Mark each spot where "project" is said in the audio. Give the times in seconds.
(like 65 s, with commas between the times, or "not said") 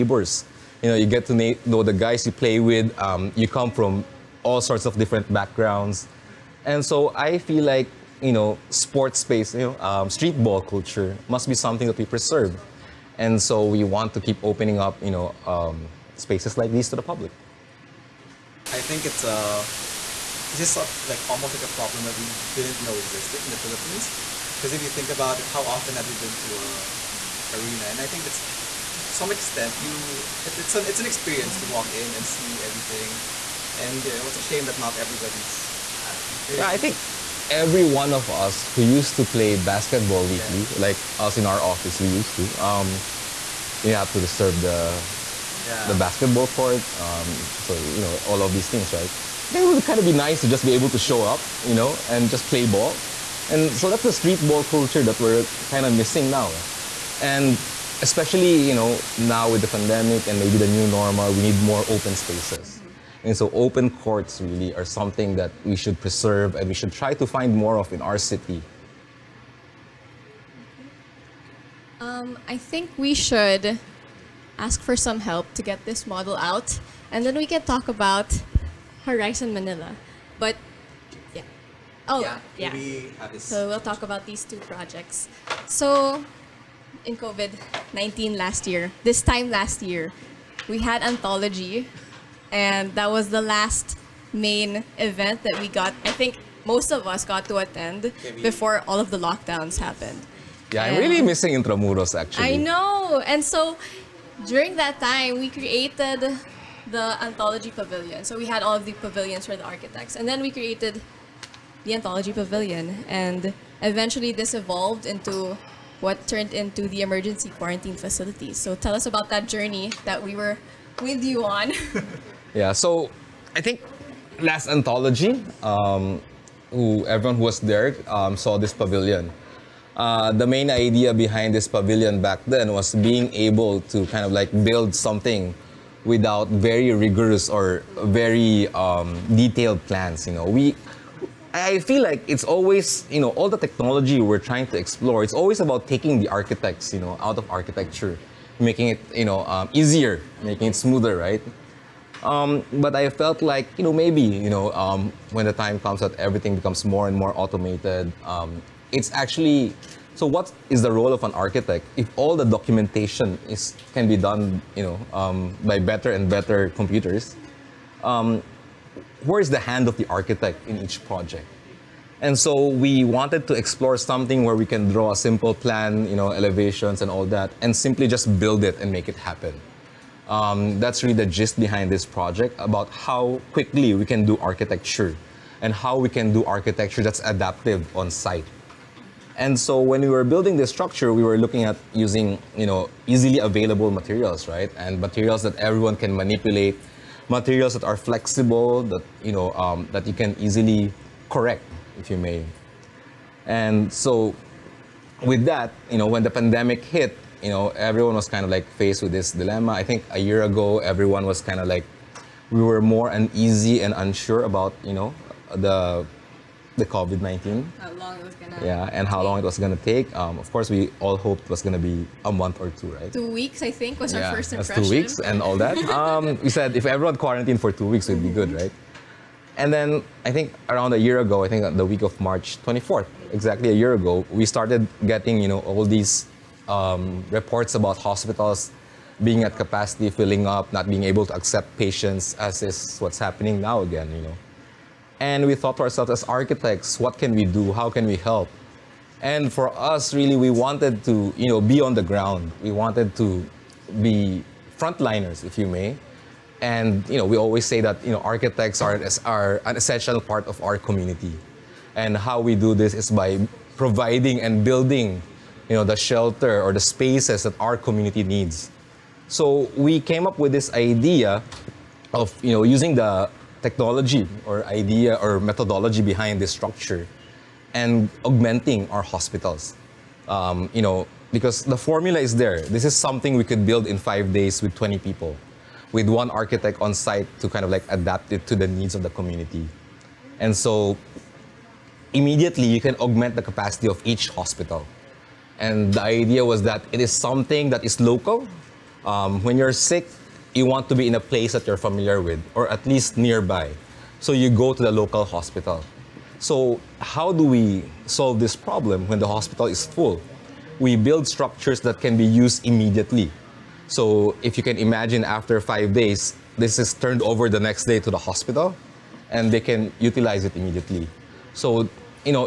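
84 s, 171 s, 182 s.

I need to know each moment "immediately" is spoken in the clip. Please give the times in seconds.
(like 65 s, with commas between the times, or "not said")
292 s, 312 s, 320 s.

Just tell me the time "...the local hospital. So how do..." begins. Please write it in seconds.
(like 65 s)
304 s.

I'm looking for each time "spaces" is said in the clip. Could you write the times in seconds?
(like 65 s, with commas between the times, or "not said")
9 s, 16 s, 62 s, 266 s.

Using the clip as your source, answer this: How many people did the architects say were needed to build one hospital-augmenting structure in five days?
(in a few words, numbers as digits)
20.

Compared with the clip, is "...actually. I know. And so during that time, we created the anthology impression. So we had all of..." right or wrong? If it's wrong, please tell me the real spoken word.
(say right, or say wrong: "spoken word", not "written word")
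wrong: "pavilion", not "impression".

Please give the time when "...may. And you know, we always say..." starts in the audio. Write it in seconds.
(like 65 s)
255 s.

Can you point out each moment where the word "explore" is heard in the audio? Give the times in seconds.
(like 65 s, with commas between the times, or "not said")
144 s, 173 s.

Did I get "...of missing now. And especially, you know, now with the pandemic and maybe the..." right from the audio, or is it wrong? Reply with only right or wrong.
right.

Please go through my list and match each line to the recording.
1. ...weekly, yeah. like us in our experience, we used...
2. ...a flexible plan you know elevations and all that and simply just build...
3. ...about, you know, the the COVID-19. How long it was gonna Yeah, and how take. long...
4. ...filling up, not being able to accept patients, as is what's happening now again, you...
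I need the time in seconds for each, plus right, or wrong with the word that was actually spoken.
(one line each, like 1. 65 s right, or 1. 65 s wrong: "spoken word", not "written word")
1. 40 s wrong: "office", not "experience"
2. 175 s wrong: "simple", not "flexible"
3. 214 s right
4. 240 s right.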